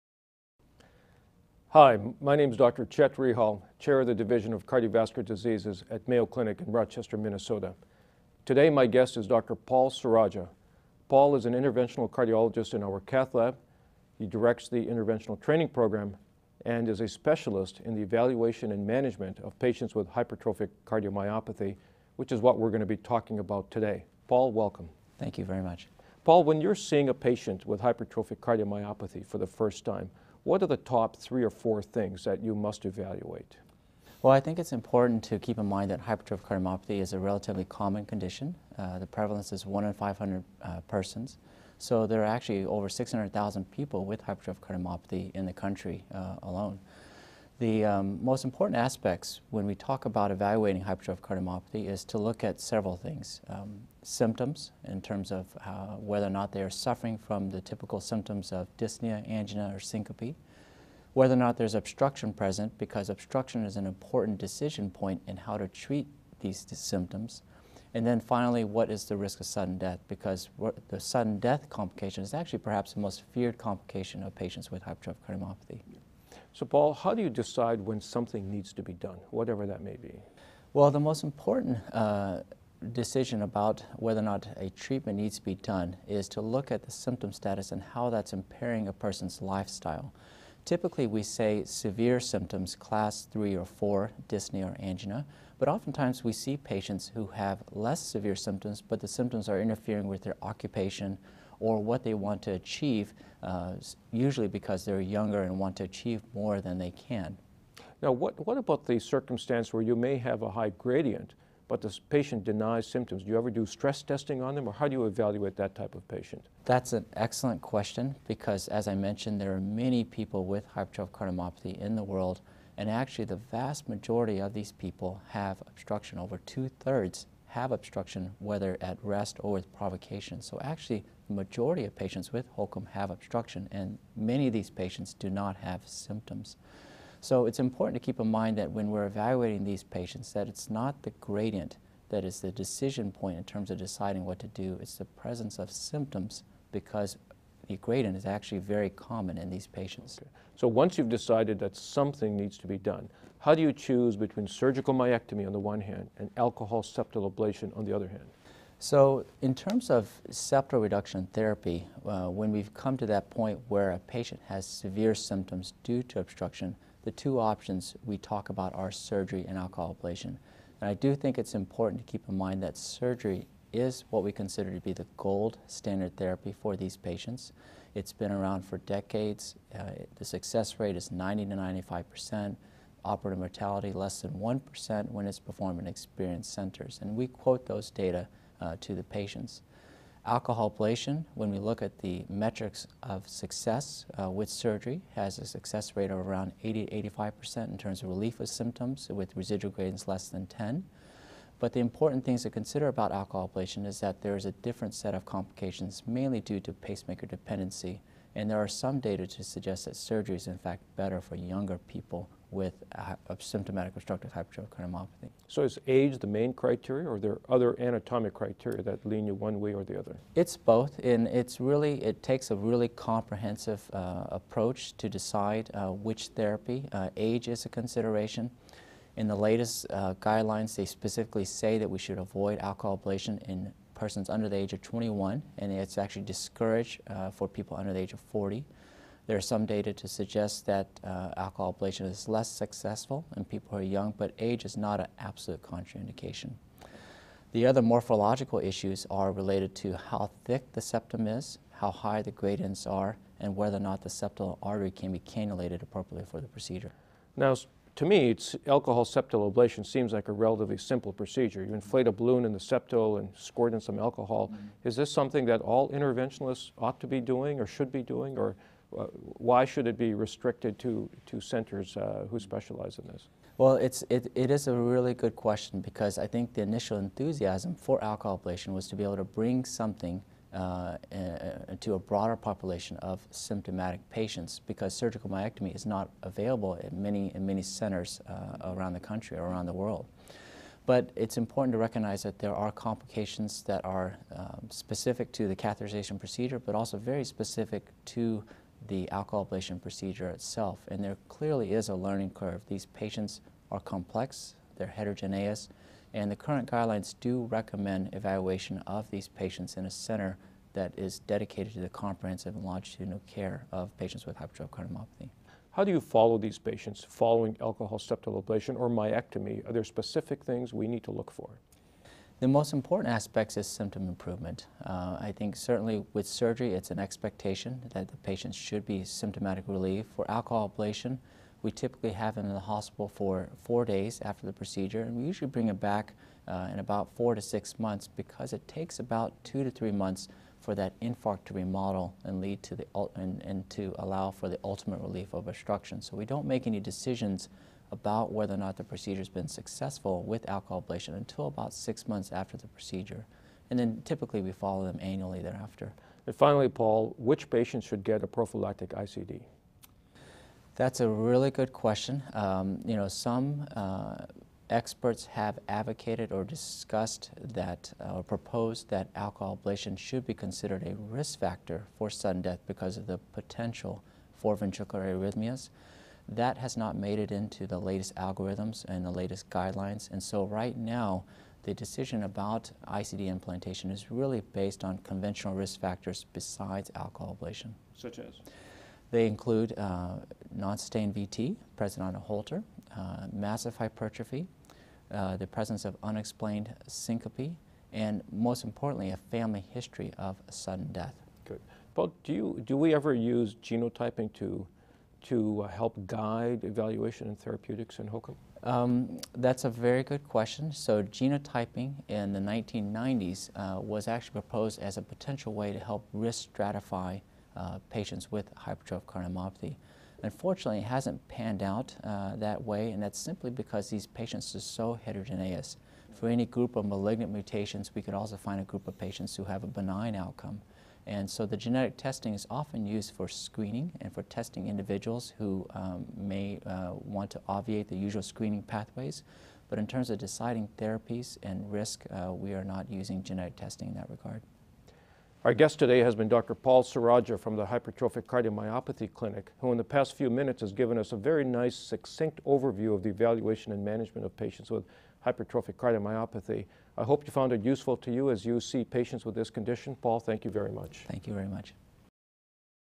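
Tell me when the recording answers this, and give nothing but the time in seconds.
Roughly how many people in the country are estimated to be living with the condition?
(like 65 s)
42 s.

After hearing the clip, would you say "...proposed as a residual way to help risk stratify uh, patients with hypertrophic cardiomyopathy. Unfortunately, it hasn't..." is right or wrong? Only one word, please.
wrong.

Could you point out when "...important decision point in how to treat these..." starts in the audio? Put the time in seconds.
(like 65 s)
63 s.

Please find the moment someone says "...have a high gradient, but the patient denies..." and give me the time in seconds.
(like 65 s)
110 s.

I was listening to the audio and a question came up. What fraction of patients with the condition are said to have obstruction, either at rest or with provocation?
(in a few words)
over two thirds.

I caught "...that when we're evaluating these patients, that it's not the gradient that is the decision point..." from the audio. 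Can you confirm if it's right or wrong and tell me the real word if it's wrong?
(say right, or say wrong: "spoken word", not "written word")
right.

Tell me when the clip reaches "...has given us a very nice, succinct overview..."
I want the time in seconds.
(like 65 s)
450 s.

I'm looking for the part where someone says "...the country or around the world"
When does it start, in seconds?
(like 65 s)
288 s.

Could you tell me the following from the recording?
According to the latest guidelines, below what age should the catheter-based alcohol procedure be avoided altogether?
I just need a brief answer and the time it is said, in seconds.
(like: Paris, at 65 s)
21, at 234 s.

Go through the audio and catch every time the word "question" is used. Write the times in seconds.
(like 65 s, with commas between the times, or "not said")
117 s, 275 s, 361 s, 410 s.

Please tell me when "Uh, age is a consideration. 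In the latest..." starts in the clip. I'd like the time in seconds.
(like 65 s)
226 s.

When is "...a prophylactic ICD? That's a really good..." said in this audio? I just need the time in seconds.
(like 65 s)
358 s.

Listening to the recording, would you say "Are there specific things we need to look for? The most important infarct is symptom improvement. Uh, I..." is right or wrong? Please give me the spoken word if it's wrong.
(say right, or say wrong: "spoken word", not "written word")
wrong: "aspect", not "infarct".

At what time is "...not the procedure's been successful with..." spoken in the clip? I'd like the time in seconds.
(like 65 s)
348 s.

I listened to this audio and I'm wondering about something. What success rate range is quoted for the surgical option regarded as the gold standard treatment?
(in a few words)
90 to 95 percent.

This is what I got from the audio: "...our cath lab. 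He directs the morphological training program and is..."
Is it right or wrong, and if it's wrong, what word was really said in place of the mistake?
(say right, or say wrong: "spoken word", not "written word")
wrong: "interventional", not "morphological".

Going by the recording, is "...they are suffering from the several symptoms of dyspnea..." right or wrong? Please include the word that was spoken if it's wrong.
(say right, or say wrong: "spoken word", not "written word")
wrong: "typical", not "several".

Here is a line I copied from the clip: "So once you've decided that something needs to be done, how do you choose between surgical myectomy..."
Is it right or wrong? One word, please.
right.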